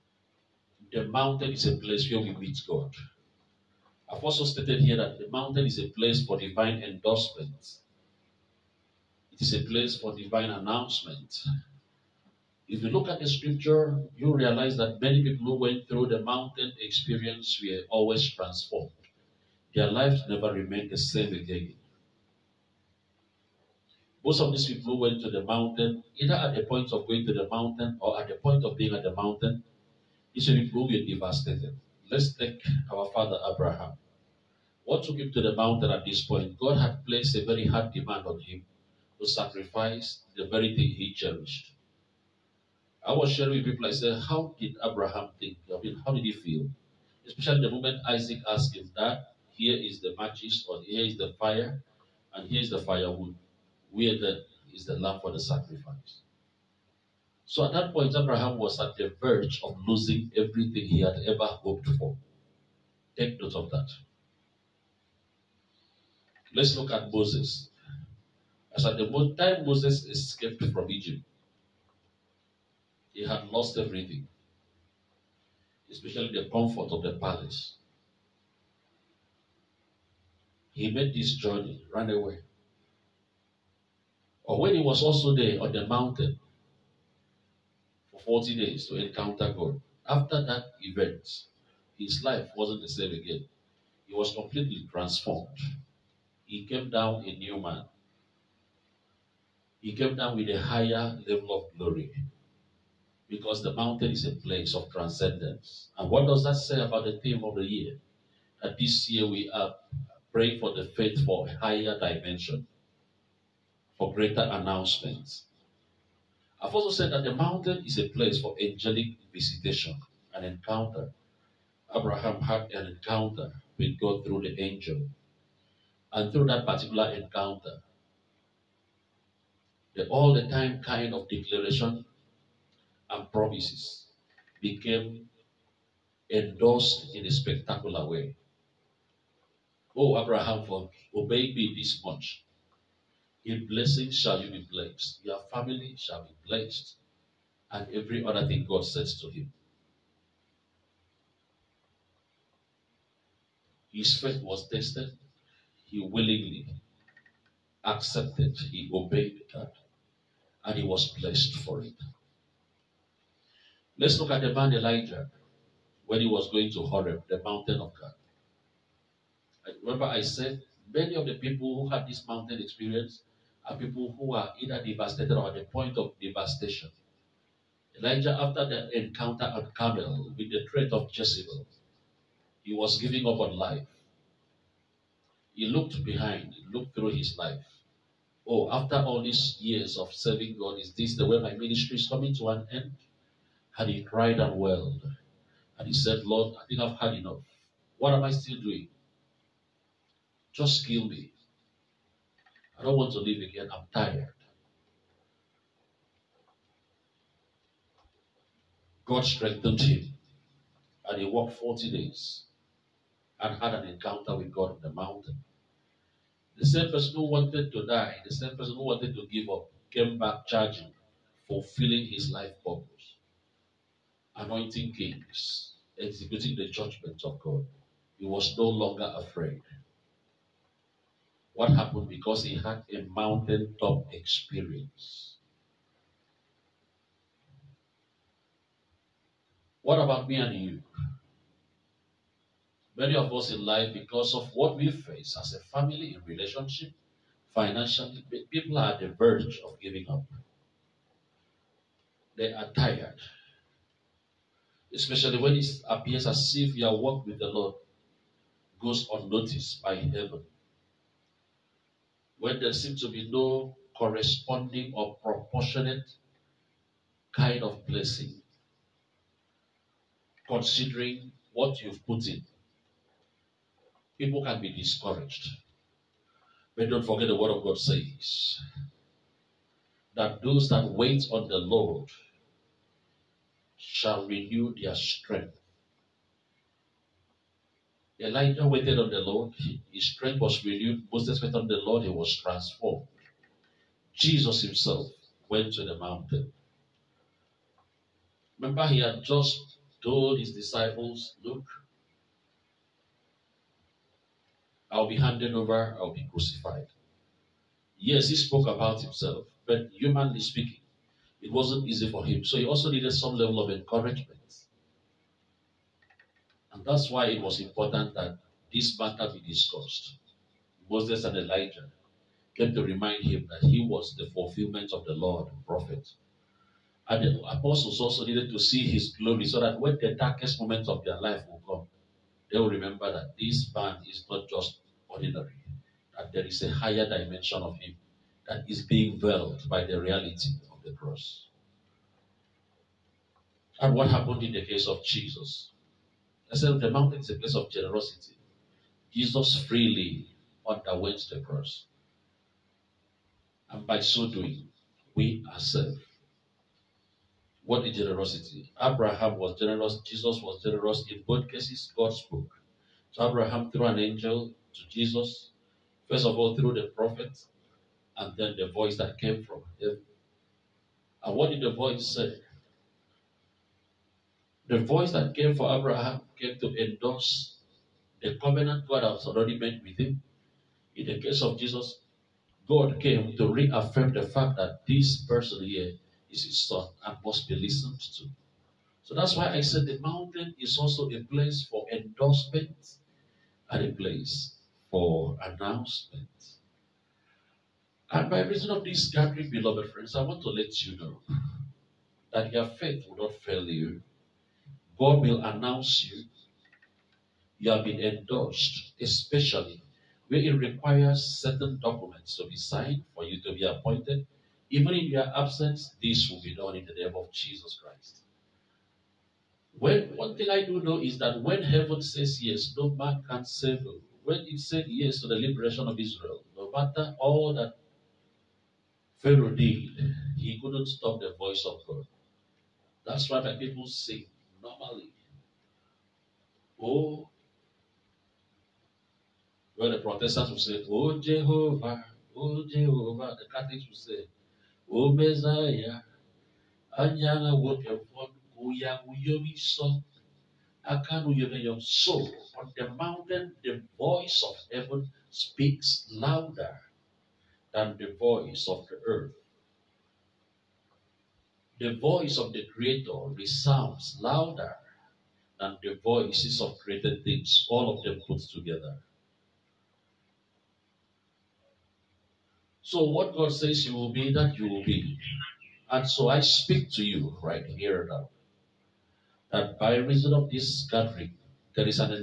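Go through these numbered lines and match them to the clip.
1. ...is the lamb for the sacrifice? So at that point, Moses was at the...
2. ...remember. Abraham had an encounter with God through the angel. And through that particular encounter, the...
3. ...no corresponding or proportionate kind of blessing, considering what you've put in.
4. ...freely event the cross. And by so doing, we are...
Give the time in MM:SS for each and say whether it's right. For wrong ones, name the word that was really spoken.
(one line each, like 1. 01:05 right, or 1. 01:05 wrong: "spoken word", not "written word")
1. 00:54 wrong: "Abraham", not "Moses"
2. 02:00 wrong: "encounter", not "remember"
3. 04:23 right
4. 05:49 wrong: "underwent", not "event".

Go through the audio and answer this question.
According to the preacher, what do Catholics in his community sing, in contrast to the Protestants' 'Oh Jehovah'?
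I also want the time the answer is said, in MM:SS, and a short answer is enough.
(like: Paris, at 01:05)
Oh Messiah, at 07:24.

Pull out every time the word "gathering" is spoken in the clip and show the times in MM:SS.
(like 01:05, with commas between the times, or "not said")
06:39, 08:00.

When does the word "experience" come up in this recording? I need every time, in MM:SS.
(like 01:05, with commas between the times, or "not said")
00:16, 02:52, 03:54.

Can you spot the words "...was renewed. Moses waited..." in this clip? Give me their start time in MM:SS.
04:50.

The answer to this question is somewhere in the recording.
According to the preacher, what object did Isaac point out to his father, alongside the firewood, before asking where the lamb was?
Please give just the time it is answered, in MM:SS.
00:50.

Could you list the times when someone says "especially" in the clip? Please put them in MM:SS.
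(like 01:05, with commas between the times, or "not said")
00:47, 01:15, 04:14, 06:49.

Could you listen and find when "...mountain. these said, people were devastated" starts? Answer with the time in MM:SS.
00:29.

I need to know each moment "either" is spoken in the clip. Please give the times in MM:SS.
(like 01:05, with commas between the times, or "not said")
00:26, 02:54.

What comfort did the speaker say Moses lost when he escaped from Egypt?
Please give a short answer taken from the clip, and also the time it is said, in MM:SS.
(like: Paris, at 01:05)
the palace, at 01:17.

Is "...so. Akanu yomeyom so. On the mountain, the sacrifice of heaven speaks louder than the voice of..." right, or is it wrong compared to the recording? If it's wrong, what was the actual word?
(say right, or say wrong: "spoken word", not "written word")
wrong: "voice", not "sacrifice".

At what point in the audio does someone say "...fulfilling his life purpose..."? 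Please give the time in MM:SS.
03:41.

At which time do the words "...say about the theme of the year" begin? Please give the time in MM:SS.
01:46.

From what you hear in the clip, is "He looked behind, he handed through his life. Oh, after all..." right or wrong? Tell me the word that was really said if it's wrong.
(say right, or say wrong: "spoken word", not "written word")
wrong: "looked", not "handed".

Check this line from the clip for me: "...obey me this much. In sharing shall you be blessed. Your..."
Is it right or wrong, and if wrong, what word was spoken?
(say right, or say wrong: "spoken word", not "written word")
wrong: "blessing", not "sharing".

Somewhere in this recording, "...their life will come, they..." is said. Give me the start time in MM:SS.
05:31.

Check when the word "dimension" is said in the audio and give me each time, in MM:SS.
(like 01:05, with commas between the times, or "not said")
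01:51, 05:37.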